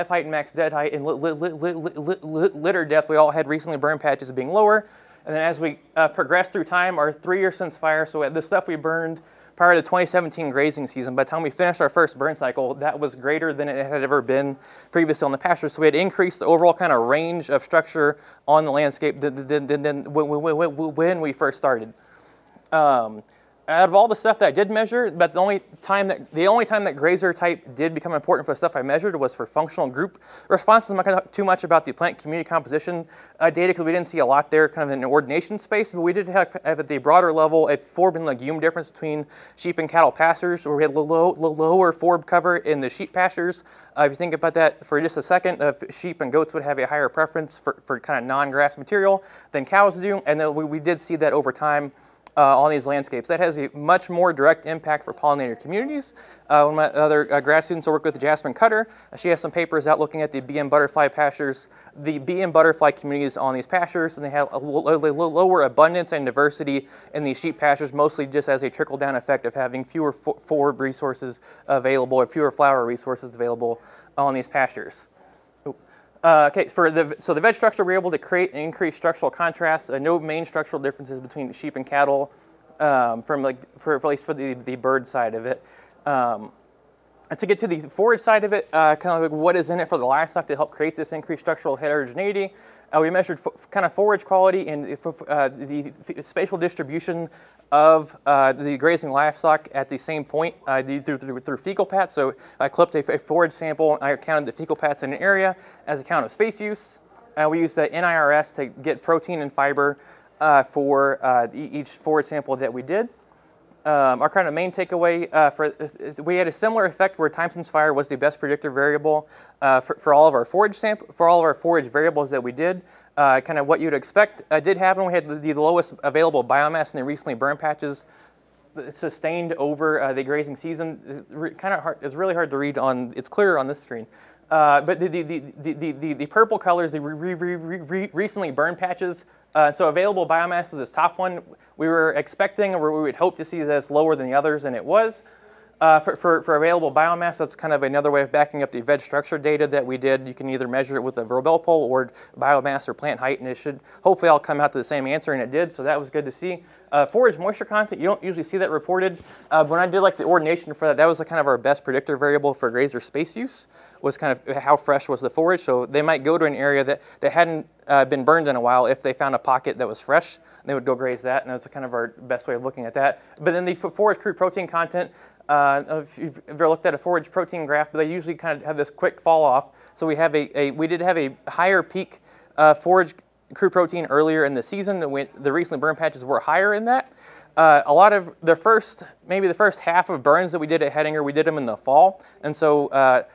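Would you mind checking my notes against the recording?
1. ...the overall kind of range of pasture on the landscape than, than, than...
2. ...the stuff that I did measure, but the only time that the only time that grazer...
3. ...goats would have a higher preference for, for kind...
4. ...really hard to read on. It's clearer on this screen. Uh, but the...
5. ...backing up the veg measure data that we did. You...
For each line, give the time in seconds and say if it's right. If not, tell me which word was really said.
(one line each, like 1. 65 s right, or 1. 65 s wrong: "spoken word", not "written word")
1. 16 s wrong: "structure", not "pasture"
2. 24 s right
3. 46 s right
4. 132 s right
5. 148 s wrong: "structure", not "measure".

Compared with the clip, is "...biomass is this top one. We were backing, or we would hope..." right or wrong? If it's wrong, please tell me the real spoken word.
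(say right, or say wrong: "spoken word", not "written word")
wrong: "expecting", not "backing".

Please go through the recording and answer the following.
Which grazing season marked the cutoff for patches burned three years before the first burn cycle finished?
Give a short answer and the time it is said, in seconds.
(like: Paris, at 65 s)
2017, at 9 s.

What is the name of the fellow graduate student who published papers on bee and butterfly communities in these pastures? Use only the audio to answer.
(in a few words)
Jasmine Cutter.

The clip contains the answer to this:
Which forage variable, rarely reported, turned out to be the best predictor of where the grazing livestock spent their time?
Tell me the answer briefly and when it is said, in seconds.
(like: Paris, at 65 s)
forage moisture content, at 157 s.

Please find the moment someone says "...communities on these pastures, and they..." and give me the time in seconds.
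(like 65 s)
62 s.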